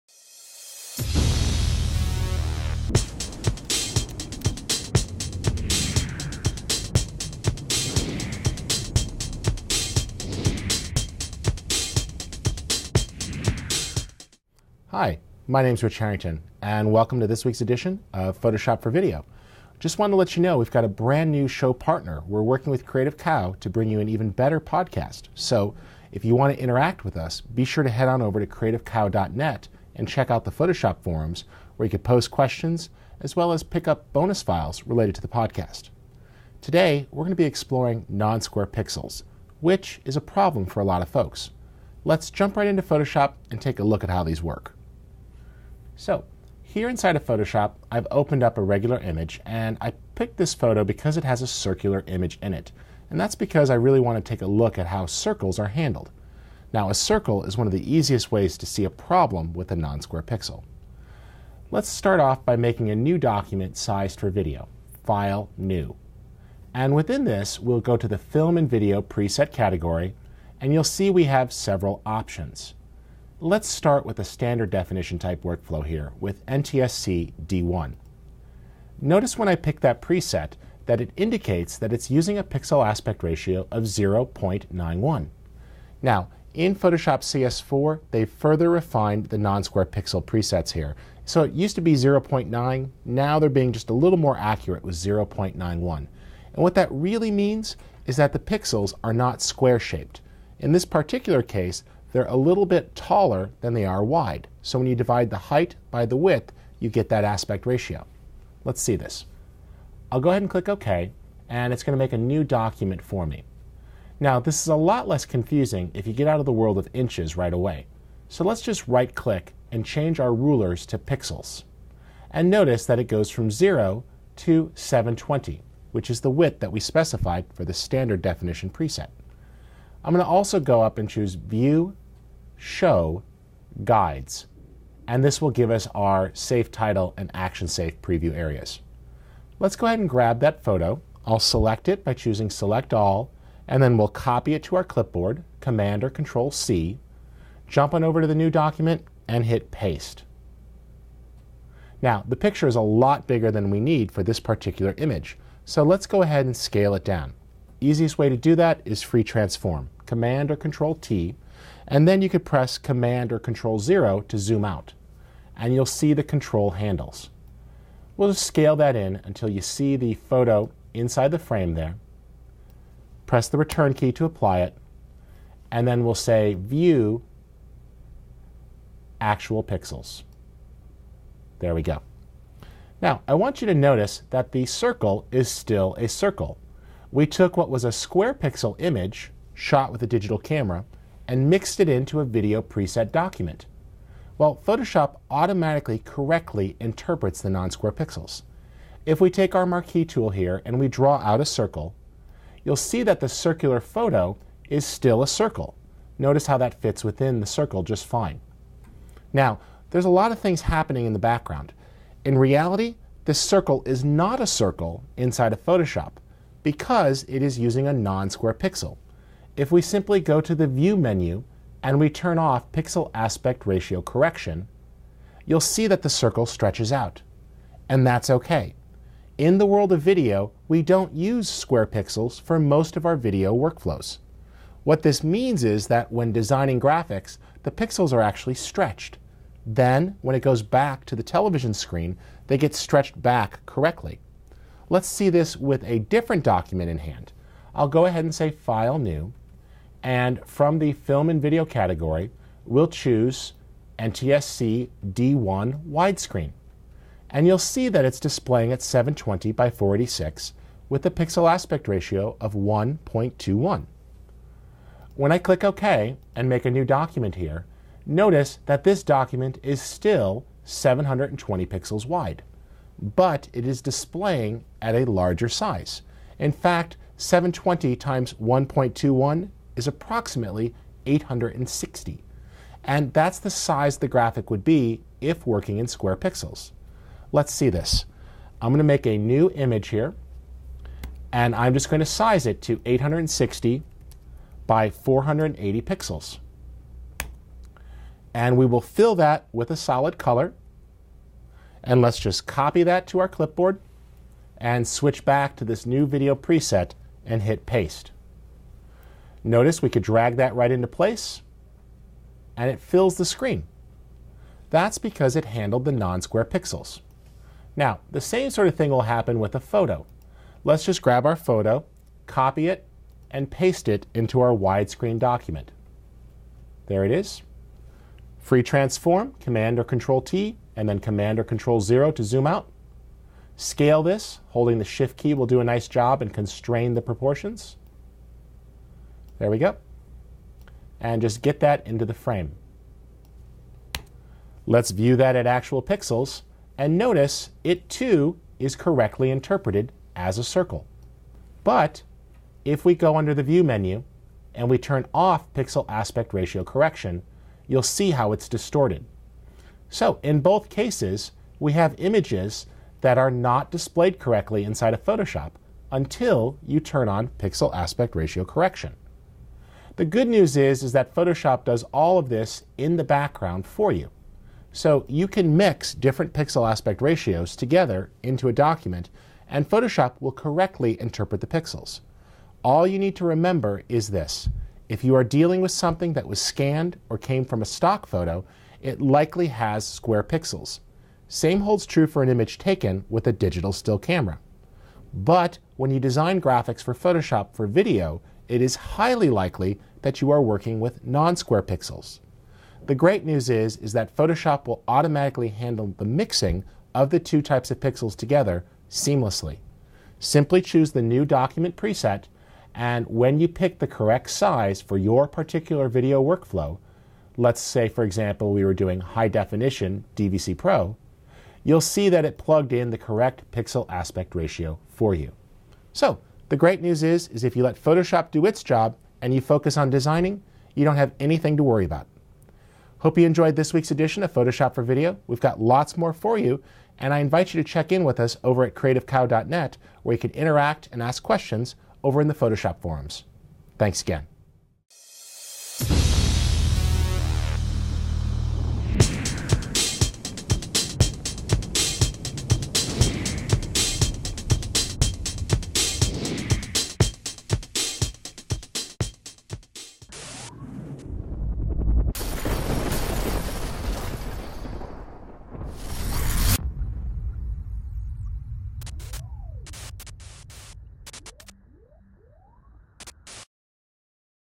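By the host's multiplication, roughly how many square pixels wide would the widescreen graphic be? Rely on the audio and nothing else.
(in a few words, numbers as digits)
860.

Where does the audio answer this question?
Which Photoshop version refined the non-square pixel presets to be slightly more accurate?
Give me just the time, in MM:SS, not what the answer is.
01:26.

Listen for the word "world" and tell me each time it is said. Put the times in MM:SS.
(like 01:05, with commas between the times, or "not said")
01:56, 03:49.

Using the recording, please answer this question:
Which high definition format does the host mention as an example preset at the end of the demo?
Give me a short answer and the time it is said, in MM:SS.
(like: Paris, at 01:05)
DVC Pro, at 07:00.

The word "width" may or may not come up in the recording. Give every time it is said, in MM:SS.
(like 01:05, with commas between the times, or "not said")
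01:46, 02:06.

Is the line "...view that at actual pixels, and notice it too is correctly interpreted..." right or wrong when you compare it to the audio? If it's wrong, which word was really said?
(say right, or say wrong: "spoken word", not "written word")
right.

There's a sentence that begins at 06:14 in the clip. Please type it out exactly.
So you can mix different pixel aspect ratios together into a document, and Photoshop will correctly interpret the pixels.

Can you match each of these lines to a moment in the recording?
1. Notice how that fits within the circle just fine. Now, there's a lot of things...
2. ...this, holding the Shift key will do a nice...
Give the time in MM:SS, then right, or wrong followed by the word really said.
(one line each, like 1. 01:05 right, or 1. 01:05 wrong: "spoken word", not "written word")
1. 03:26 right
2. 05:34 right.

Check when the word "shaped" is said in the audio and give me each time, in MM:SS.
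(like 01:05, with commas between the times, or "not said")
01:39.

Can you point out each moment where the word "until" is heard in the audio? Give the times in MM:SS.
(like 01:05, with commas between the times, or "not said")
02:49, 06:05.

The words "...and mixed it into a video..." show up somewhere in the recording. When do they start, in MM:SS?
03:11.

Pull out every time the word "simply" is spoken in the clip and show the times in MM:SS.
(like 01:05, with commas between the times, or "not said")
03:39, 06:50.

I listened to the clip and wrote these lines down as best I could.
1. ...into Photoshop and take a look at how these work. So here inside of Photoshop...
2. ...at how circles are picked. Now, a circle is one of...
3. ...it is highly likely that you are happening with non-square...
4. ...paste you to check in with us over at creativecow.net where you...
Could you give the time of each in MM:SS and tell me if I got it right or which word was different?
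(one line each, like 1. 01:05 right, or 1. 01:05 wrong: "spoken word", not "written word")
1. 00:42 right
2. 00:54 wrong: "handled", not "picked"
3. 06:38 wrong: "working", not "happening"
4. 07:17 wrong: "invite", not "paste".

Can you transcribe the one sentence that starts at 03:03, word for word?
Now, I want you to notice that the circle is still a circle.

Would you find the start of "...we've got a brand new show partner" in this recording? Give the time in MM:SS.
00:20.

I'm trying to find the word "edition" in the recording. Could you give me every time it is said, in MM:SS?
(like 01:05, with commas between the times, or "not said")
00:17, 07:13.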